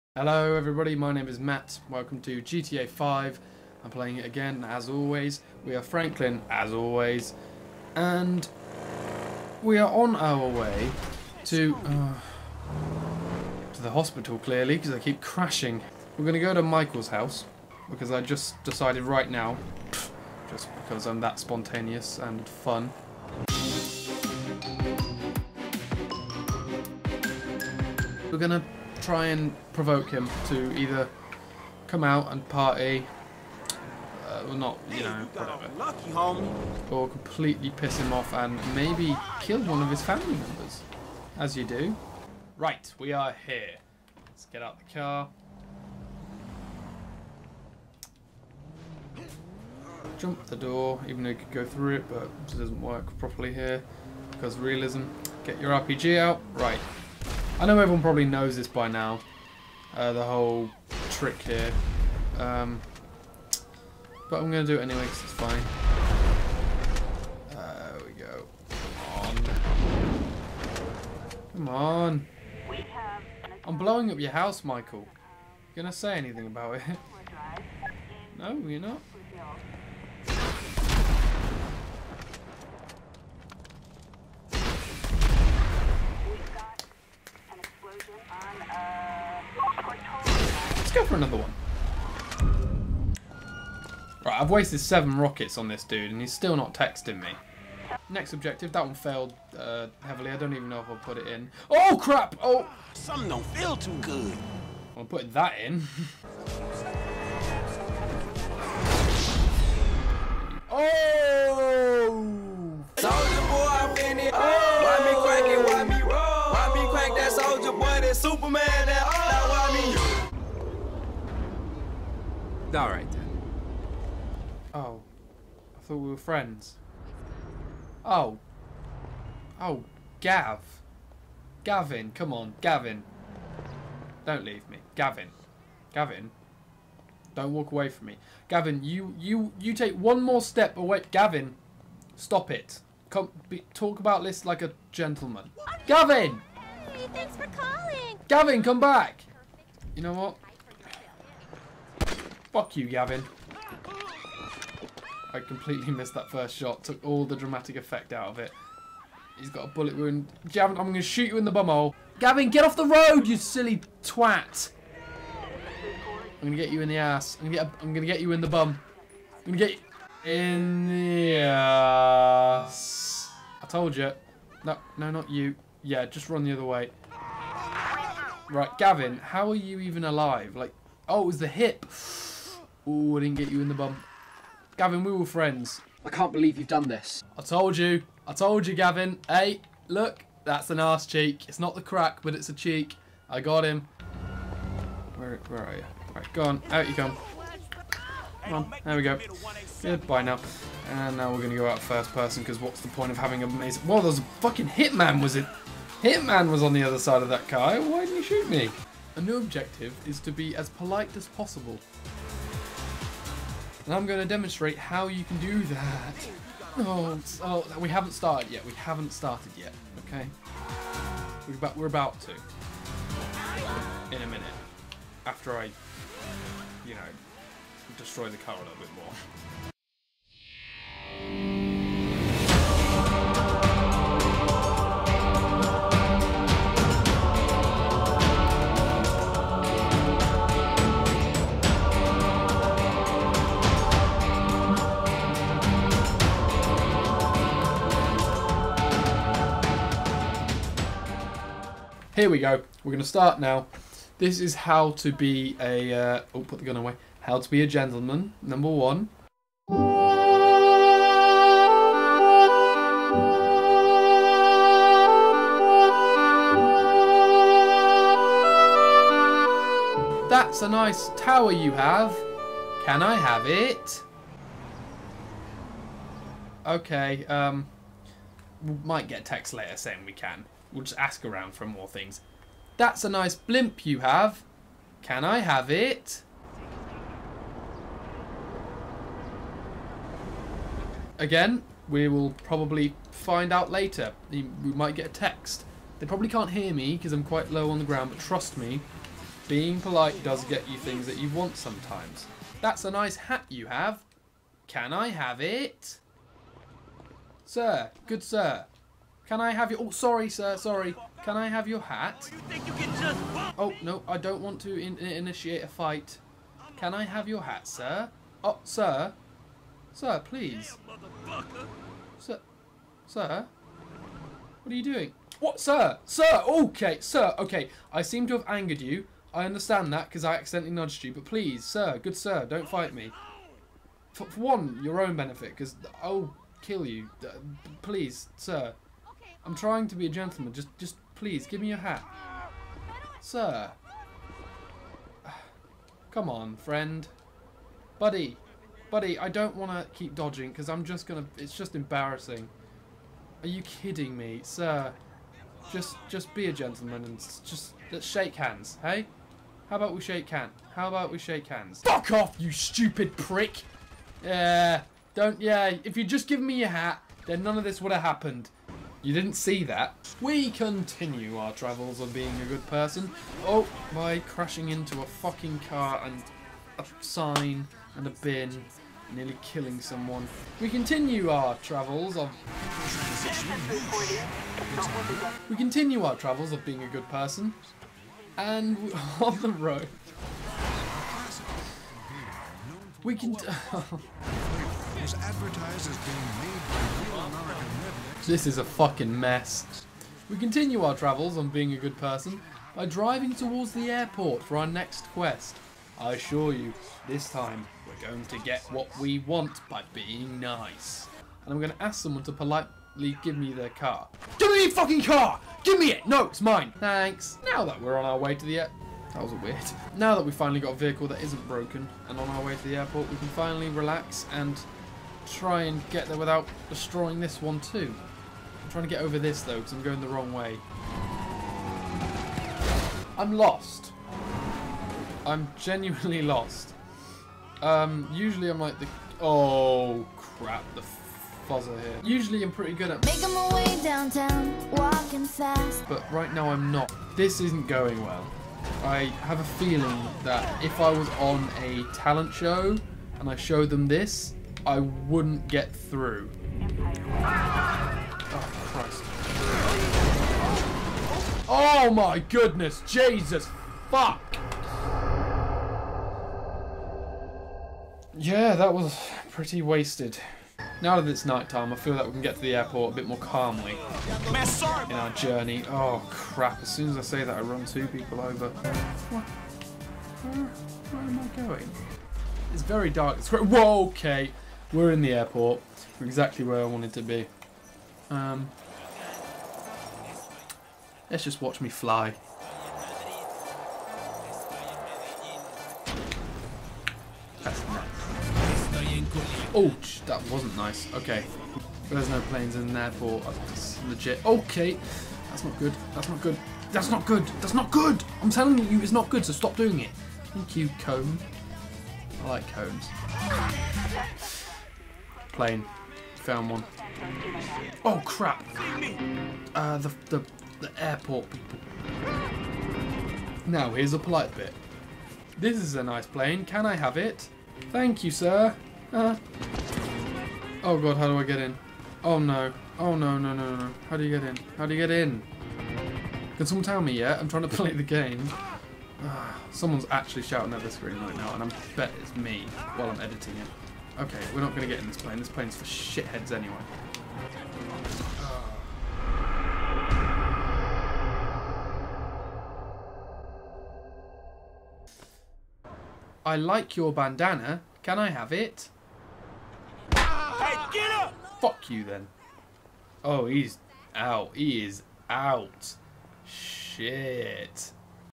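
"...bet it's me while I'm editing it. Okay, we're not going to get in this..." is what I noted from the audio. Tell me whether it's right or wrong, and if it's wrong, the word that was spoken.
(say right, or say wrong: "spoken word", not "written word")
right.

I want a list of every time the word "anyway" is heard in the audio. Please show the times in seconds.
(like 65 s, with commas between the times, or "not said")
64 s, 546 s.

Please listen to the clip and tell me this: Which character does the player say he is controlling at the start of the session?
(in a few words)
Franklin.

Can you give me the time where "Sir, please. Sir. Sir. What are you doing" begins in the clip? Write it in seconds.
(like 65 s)
319 s.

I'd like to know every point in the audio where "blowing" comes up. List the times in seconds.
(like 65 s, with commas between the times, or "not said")
73 s.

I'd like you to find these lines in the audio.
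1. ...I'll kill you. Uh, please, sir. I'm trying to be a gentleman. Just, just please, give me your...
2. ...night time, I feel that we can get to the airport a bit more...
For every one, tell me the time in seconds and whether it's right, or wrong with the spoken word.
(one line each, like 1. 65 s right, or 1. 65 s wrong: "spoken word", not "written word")
1. 336 s right
2. 471 s right.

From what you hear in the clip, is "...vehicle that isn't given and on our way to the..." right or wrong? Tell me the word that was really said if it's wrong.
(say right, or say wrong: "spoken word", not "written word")
wrong: "broken", not "given".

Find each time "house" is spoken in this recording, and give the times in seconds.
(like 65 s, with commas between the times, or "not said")
17 s, 74 s.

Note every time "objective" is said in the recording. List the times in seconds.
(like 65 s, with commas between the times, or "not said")
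98 s, 209 s.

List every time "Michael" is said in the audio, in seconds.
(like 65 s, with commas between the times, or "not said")
16 s, 74 s.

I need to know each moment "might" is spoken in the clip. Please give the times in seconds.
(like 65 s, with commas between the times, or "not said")
278 s, 294 s.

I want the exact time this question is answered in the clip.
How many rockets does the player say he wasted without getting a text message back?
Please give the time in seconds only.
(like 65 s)
94 s.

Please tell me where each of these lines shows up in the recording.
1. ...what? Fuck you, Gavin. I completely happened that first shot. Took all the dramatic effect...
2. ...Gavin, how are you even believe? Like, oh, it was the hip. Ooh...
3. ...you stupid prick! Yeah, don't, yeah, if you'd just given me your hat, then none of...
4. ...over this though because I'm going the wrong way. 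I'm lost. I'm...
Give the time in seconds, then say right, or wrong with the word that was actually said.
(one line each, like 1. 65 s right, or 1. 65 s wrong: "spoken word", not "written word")
1. 150 s wrong: "missed", not "happened"
2. 178 s wrong: "alive", not "believe"
3. 362 s right
4. 429 s right.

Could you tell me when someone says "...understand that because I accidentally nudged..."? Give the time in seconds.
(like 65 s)
329 s.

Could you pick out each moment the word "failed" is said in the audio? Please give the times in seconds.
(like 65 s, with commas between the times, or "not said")
98 s.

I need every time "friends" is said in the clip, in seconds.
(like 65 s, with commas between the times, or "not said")
126 s, 185 s, 346 s.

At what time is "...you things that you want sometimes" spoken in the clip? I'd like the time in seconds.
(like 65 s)
300 s.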